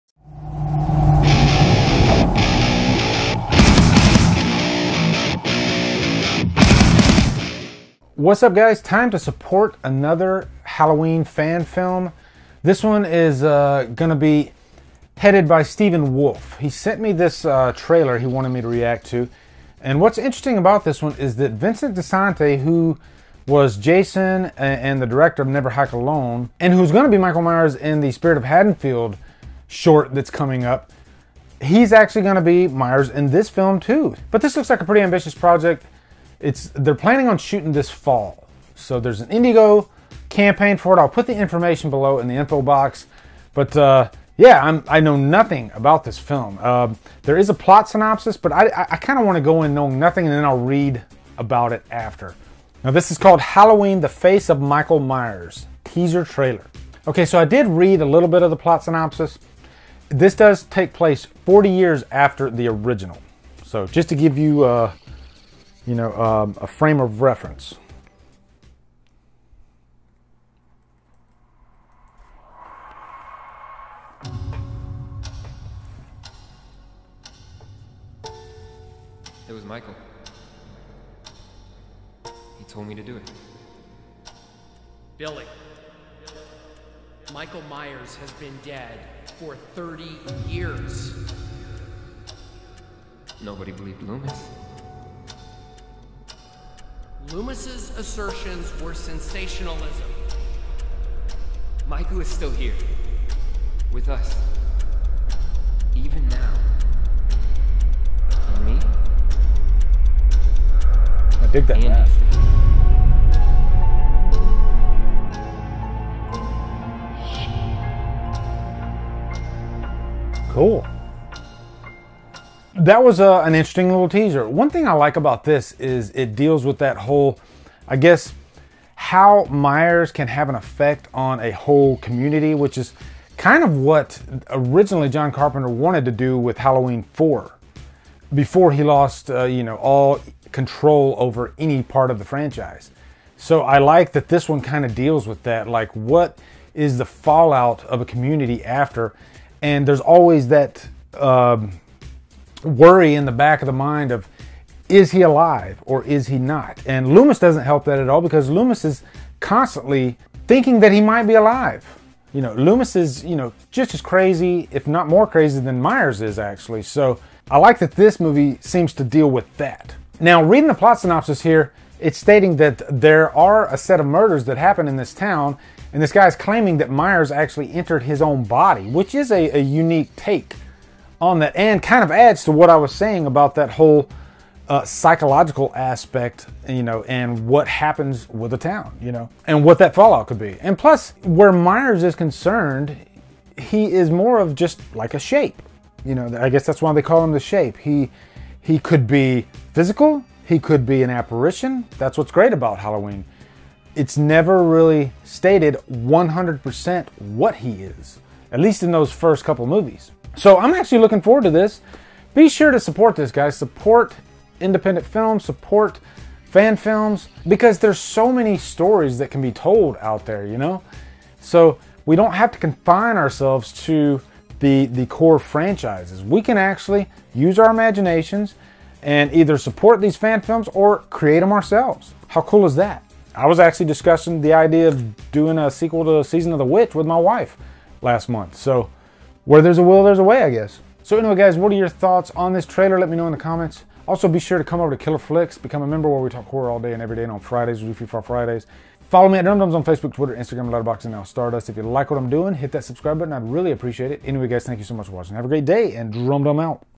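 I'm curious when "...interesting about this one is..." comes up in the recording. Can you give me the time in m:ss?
0:20.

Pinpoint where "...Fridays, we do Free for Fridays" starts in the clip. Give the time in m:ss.
4:07.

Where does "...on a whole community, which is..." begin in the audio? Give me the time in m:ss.
2:11.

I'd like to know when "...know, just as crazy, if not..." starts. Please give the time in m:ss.
2:43.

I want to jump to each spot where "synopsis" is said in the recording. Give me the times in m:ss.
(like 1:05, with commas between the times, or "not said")
0:47, 0:58, 2:50.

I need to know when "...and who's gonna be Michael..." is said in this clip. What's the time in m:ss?
0:26.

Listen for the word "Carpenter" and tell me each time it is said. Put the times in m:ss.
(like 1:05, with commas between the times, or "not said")
2:15.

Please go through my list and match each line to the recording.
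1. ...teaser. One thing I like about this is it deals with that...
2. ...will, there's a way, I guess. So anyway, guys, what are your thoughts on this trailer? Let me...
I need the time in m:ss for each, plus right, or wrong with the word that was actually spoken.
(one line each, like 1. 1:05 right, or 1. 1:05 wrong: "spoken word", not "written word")
1. 2:04 right
2. 3:59 right.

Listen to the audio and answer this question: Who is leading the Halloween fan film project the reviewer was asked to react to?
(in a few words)
Stephen Wolf.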